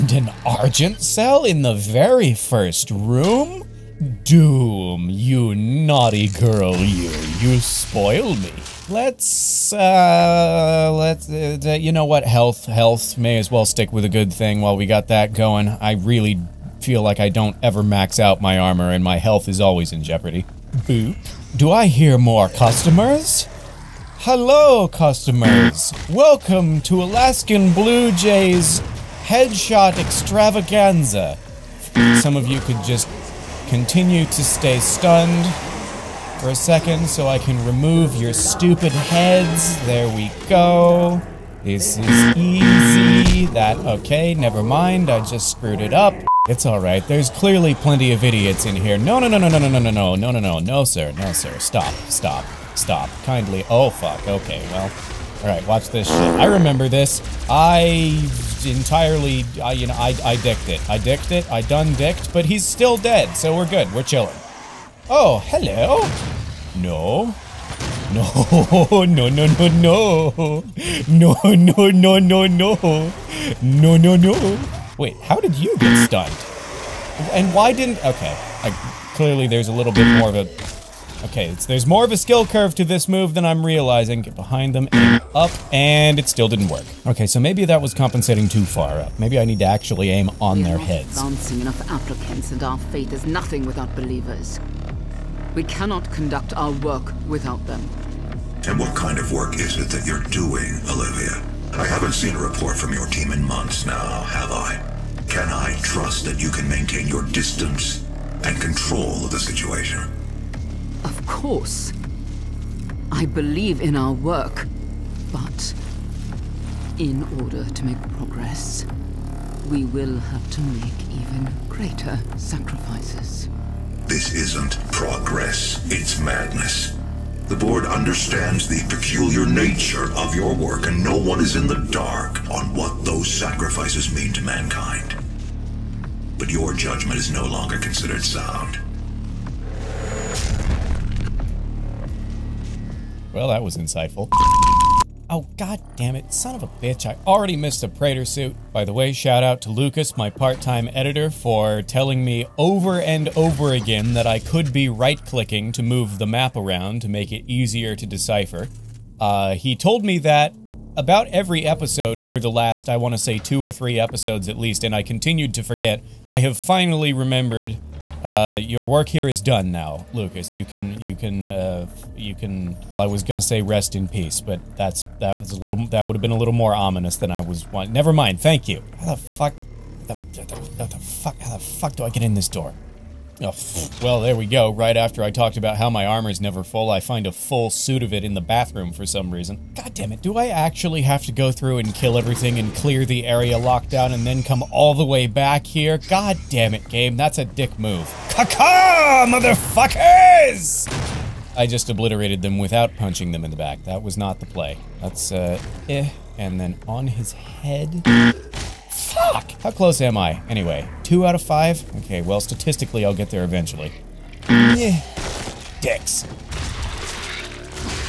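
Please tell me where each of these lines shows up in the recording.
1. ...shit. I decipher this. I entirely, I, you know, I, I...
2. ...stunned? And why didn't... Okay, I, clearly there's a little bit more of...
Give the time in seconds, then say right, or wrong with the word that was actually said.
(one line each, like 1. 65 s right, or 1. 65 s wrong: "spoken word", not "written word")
1. 56 s wrong: "remember", not "decipher"
2. 76 s right.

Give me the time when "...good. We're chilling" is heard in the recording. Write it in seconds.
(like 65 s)
63 s.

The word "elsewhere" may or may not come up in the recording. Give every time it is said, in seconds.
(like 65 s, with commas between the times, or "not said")
not said.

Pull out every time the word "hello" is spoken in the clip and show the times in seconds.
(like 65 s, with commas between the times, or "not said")
24 s, 65 s.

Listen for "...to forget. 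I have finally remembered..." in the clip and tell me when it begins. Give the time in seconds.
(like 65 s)
165 s.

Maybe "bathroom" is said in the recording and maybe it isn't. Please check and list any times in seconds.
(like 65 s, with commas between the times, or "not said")
188 s.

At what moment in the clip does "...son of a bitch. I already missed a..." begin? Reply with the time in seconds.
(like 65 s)
146 s.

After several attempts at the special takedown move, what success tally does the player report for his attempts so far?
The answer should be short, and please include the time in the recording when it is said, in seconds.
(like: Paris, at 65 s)
2 out of 5, at 211 s.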